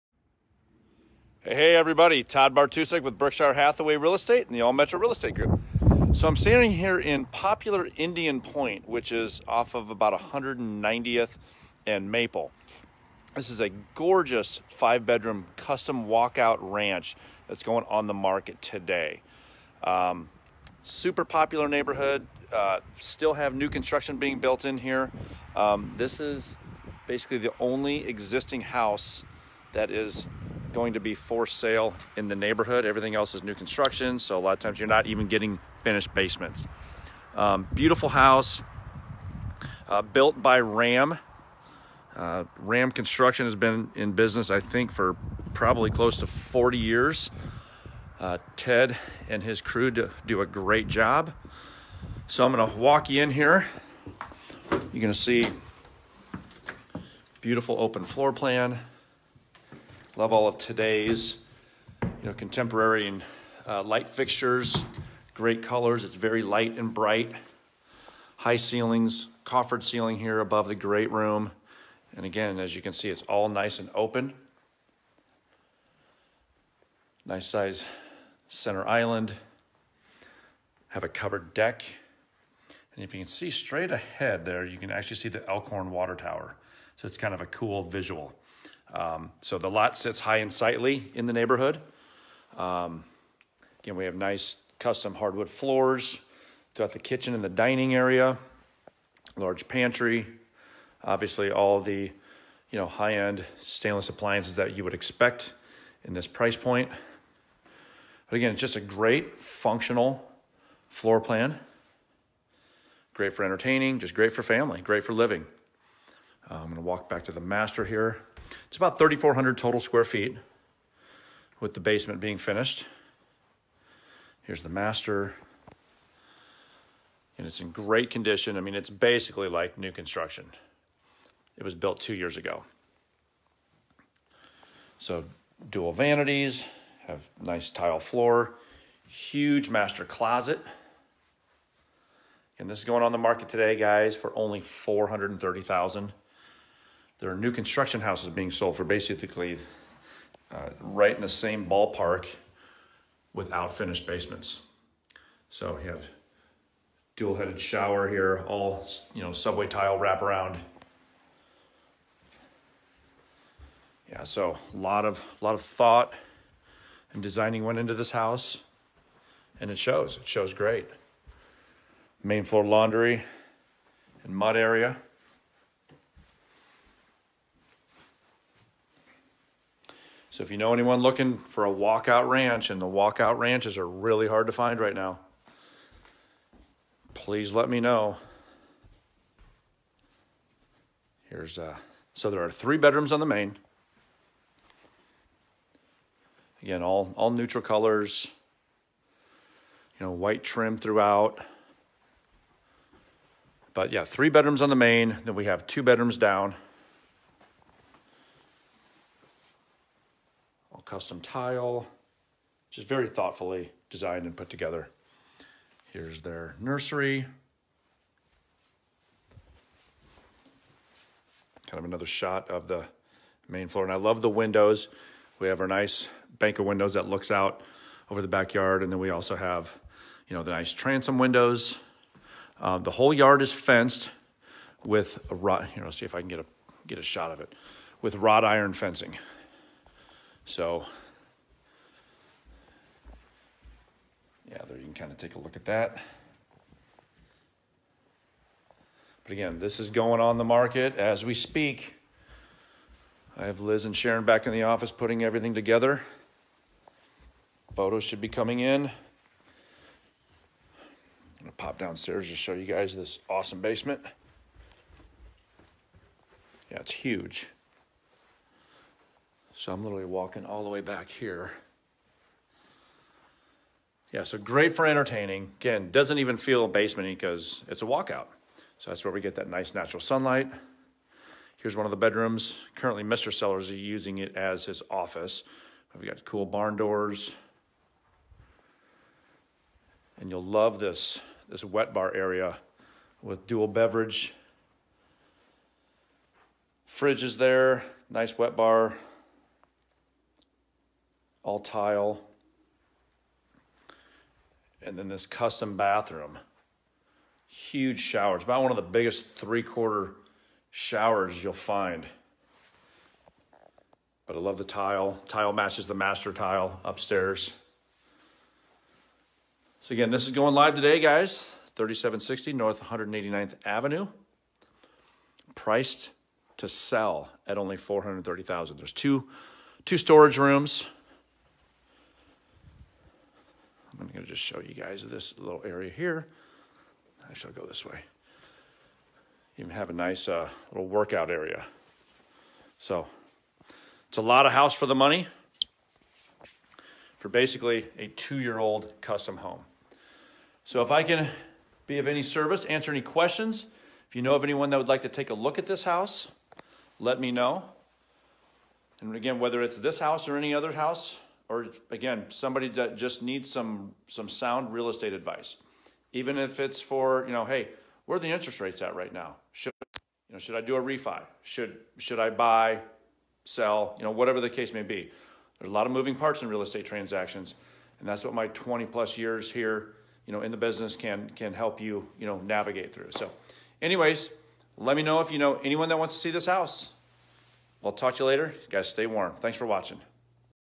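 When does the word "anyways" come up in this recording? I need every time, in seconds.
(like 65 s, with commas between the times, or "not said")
383 s.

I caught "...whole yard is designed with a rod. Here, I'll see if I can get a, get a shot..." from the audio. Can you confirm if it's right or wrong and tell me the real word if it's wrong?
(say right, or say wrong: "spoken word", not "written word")
wrong: "fenced", not "designed".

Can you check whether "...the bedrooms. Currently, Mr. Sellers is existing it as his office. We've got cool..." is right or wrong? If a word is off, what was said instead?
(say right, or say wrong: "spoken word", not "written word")
wrong: "using", not "existing".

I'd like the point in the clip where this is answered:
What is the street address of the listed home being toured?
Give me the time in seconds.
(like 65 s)
321 s.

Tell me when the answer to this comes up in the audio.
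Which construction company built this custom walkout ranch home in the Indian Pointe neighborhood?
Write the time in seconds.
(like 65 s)
42 s.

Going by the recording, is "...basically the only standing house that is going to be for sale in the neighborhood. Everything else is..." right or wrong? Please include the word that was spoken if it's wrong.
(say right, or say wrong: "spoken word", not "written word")
wrong: "existing", not "standing".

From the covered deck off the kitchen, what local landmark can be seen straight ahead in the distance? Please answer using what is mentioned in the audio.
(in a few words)
Elkhorn Water Tower.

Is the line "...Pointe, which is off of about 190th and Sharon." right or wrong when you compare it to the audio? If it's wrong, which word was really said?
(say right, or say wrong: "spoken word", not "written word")
wrong: "Maple", not "Sharon".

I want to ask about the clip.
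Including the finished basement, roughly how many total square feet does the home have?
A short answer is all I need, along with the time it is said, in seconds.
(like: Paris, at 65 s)
3,400, at 118 s.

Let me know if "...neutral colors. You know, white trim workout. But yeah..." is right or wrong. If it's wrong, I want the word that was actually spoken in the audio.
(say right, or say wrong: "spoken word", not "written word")
wrong: "throughout", not "workout".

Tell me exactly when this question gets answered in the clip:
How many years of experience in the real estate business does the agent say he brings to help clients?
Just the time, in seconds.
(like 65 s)
378 s.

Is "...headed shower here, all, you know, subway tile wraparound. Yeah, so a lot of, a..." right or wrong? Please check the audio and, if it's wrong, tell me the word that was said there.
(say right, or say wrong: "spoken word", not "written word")
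right.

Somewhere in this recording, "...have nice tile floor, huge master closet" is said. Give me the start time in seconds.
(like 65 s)
137 s.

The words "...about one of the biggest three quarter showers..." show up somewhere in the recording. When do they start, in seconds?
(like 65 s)
308 s.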